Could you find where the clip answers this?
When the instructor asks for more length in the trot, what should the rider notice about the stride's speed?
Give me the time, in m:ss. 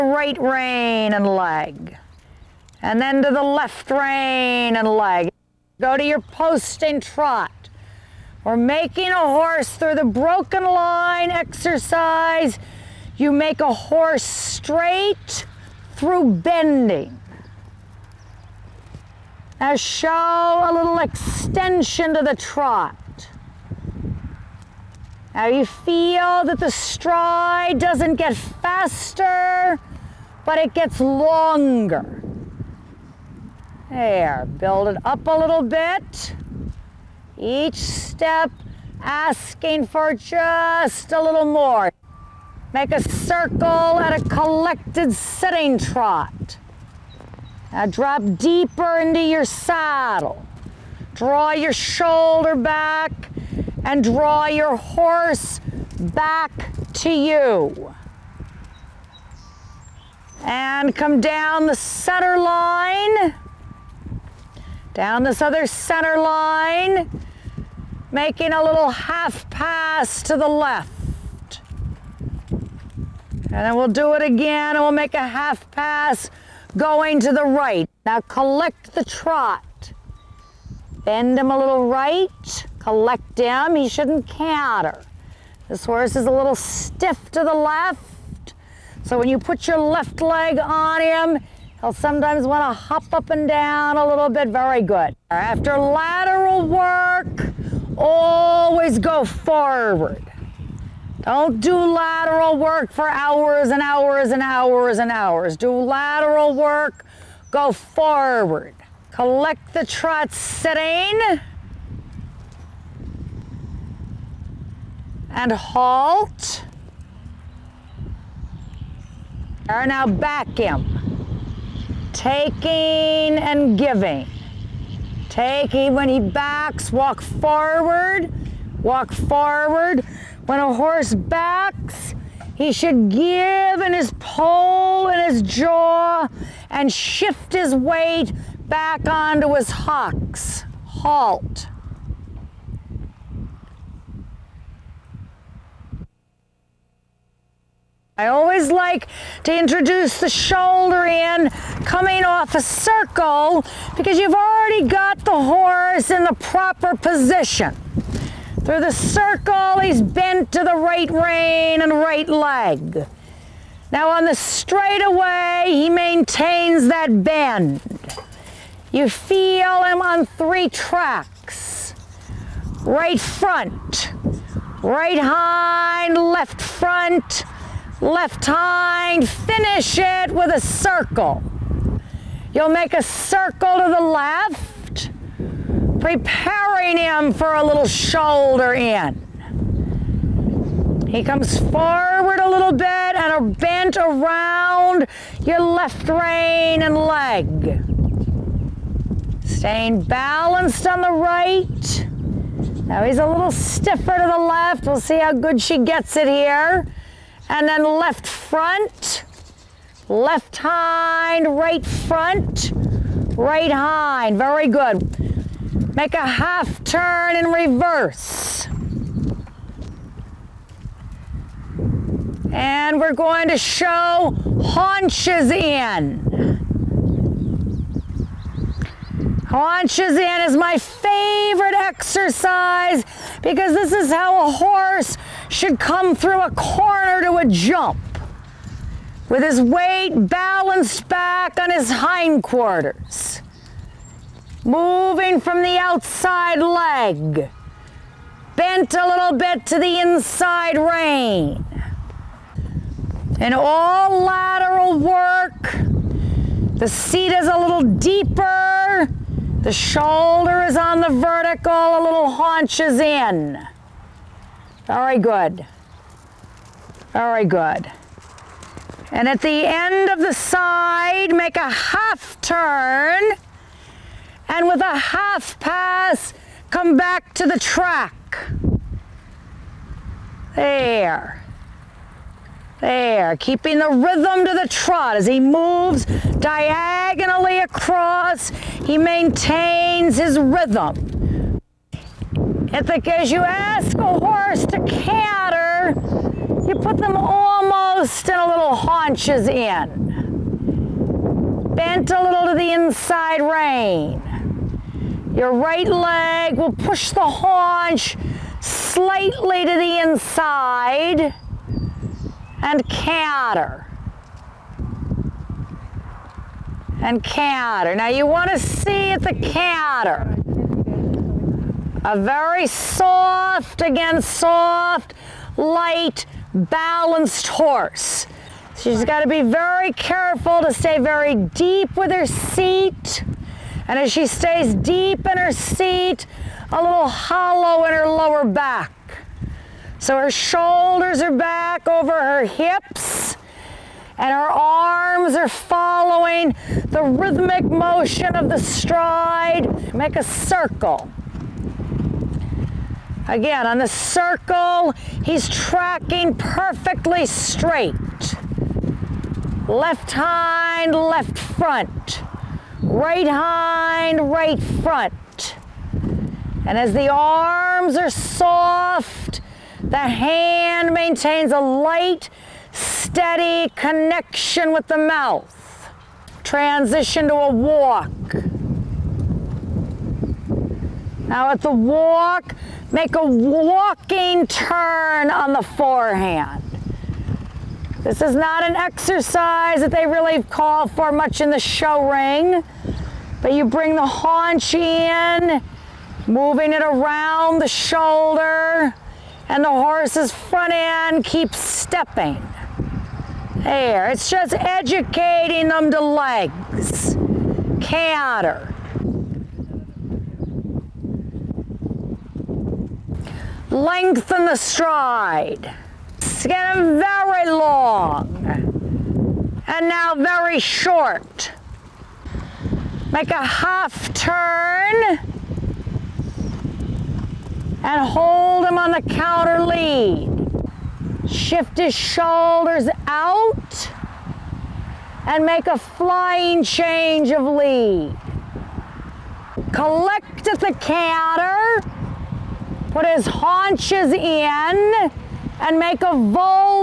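0:26.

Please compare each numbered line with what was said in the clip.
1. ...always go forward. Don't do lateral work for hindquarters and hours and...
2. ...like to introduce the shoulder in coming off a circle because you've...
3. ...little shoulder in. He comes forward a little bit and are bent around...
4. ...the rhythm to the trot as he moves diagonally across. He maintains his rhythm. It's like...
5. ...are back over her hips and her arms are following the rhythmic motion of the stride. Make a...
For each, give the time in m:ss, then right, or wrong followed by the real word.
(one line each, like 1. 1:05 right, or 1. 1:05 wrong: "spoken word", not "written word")
1. 1:37 wrong: "hours", not "hindquarters"
2. 2:28 right
3. 3:07 right
4. 4:43 right
5. 5:41 right.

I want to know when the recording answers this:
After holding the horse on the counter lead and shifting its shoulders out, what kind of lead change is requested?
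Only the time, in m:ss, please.
7:15.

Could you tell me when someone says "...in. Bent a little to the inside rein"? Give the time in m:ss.
4:59.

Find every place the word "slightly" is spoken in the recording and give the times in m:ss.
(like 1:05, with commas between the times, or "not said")
5:08.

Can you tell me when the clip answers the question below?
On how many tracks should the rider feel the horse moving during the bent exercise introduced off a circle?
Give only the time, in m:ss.
2:50.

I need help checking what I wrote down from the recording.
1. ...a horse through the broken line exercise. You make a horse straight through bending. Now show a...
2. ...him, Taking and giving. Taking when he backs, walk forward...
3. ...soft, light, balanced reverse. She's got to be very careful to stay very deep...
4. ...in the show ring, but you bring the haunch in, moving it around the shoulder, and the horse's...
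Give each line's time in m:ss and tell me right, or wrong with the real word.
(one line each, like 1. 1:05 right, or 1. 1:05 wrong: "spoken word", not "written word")
1. 0:09 right
2. 2:00 right
3. 5:24 wrong: "horse", not "reverse"
4. 6:31 right.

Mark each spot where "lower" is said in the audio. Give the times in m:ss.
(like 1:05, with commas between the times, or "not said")
5:38.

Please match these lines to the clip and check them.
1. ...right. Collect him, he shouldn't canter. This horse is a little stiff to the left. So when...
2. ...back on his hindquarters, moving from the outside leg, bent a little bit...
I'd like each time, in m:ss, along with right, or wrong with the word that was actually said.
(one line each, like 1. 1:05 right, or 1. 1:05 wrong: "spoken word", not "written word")
1. 1:21 right
2. 4:01 right.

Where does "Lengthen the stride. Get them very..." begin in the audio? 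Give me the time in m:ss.
6:53.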